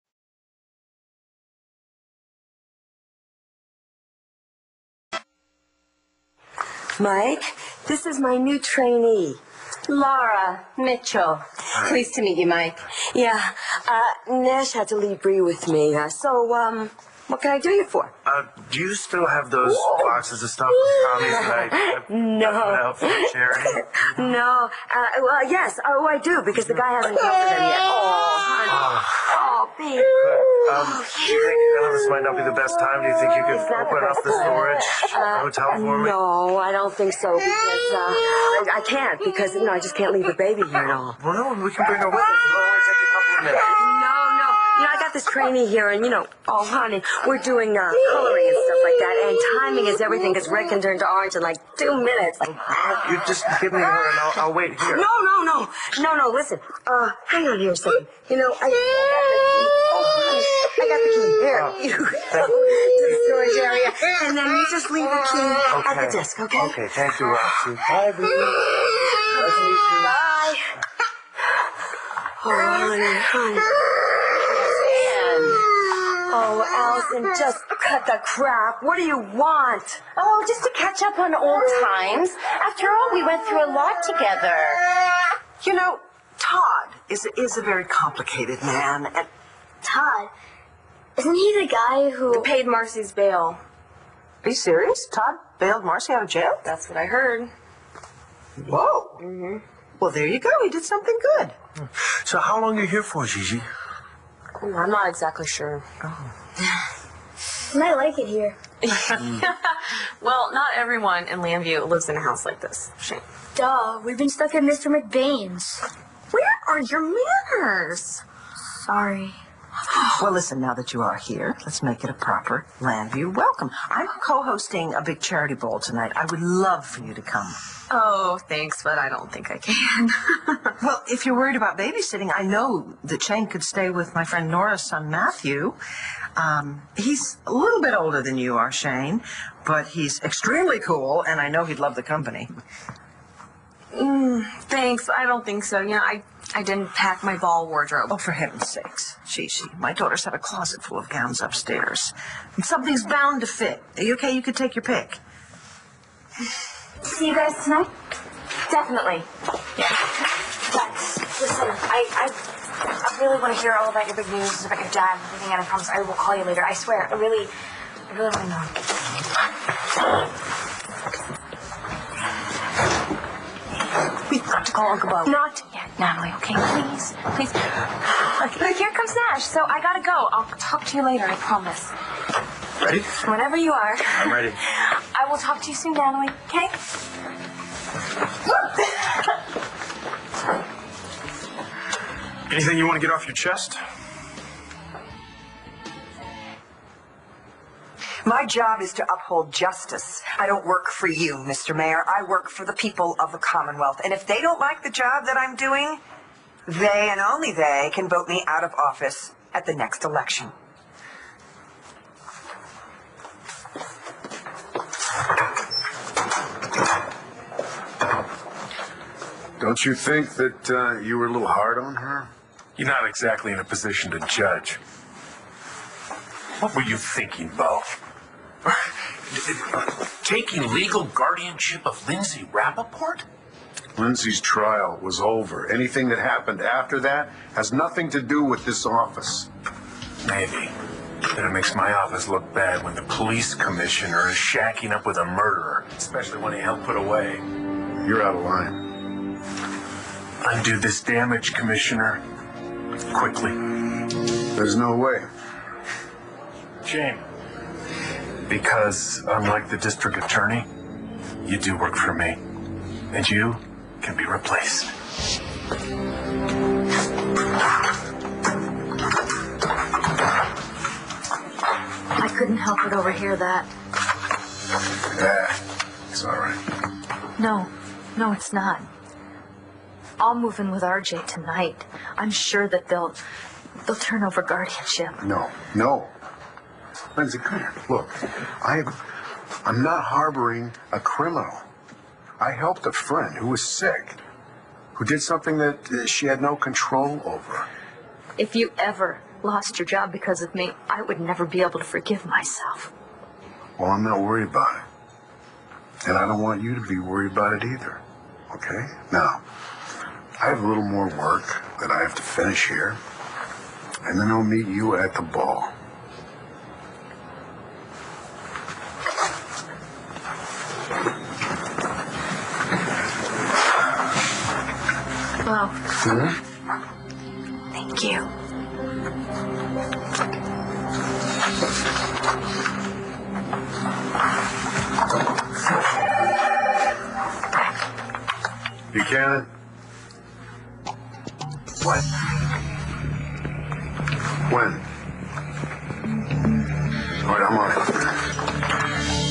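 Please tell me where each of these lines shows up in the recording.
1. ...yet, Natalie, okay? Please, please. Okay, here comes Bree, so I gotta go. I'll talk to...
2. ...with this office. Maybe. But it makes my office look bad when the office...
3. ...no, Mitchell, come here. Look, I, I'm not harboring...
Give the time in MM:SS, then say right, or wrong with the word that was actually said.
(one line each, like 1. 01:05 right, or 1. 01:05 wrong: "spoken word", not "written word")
1. 02:55 wrong: "Nash", not "Bree"
2. 03:58 wrong: "police", not "office"
3. 04:45 wrong: "Lindsay", not "Mitchell".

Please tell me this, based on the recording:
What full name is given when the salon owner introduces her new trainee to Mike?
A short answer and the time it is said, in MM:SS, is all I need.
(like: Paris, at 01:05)
Laura Mitchell, at 00:09.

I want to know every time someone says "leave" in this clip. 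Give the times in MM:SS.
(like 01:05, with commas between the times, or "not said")
00:14, 00:40, 01:04.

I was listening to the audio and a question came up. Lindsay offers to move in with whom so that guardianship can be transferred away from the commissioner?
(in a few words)
RJ.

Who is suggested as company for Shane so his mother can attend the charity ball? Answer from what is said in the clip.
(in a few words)
Matthew.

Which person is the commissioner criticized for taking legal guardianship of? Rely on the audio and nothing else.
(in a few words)
Lindsay Rappaport.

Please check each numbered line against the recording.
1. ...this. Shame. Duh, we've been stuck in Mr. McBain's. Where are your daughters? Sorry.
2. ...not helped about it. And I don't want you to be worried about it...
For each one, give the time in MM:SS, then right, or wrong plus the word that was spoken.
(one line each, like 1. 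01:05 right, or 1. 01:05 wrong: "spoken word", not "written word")
1. 01:52 wrong: "manners", not "daughters"
2. 05:04 wrong: "worried", not "helped".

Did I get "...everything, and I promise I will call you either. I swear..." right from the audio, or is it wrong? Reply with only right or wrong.
wrong.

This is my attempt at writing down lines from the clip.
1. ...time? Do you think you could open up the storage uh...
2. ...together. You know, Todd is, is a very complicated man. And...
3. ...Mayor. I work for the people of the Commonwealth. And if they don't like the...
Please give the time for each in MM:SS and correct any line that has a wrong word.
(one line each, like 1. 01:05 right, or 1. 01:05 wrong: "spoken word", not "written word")
1. 00:32 right
2. 01:24 right
3. 03:21 right.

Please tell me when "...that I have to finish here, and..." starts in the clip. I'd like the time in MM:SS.
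05:11.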